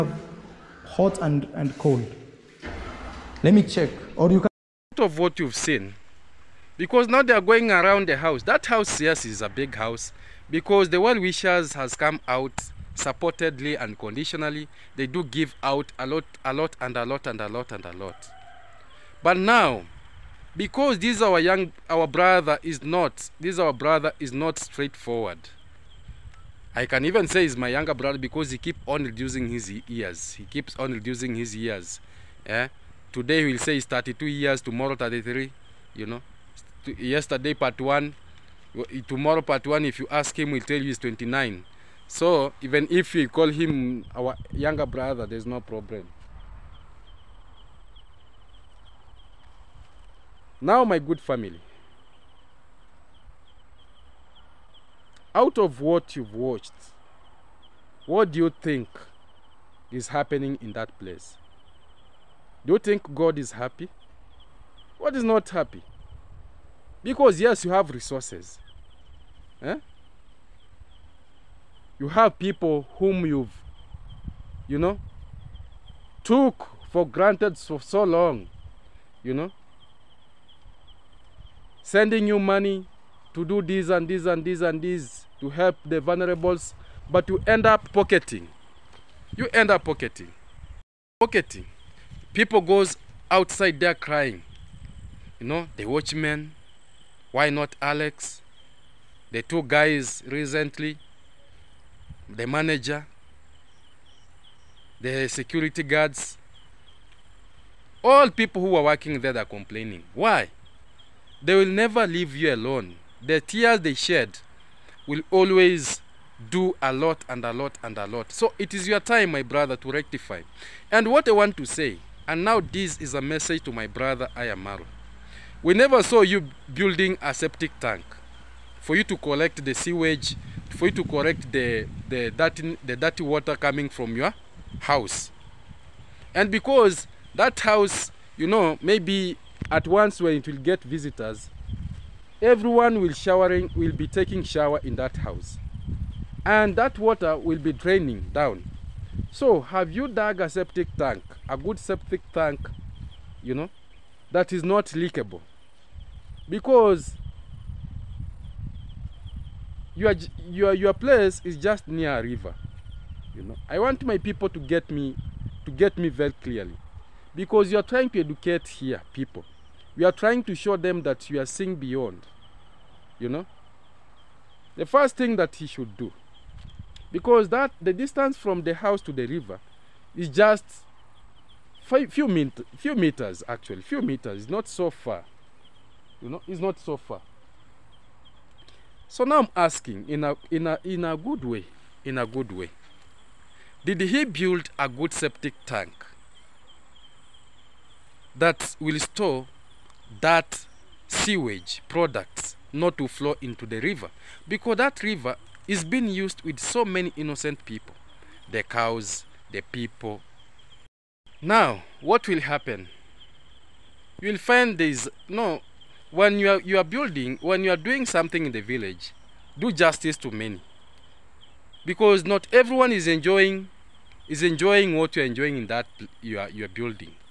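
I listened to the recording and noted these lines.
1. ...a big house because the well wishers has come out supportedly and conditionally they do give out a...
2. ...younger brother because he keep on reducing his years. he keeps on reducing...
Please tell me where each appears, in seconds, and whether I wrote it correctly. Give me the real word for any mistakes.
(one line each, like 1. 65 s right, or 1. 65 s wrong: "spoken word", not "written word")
1. 9 s right
2. 27 s right.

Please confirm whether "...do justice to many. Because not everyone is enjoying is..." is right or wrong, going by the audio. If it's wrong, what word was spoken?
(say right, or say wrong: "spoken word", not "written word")
right.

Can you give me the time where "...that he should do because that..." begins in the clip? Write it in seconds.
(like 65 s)
175 s.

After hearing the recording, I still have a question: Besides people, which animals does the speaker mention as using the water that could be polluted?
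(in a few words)
cows.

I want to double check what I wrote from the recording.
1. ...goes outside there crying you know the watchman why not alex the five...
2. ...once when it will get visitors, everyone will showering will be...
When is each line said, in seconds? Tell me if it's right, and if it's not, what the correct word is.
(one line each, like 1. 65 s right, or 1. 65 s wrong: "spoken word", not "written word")
1. 92 s wrong: "two", not "five"
2. 139 s right.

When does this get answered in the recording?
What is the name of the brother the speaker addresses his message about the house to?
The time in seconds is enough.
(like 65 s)
124 s.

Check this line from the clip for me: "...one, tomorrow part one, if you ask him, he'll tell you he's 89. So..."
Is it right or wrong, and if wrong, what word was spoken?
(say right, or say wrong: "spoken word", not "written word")
wrong: "29", not "89".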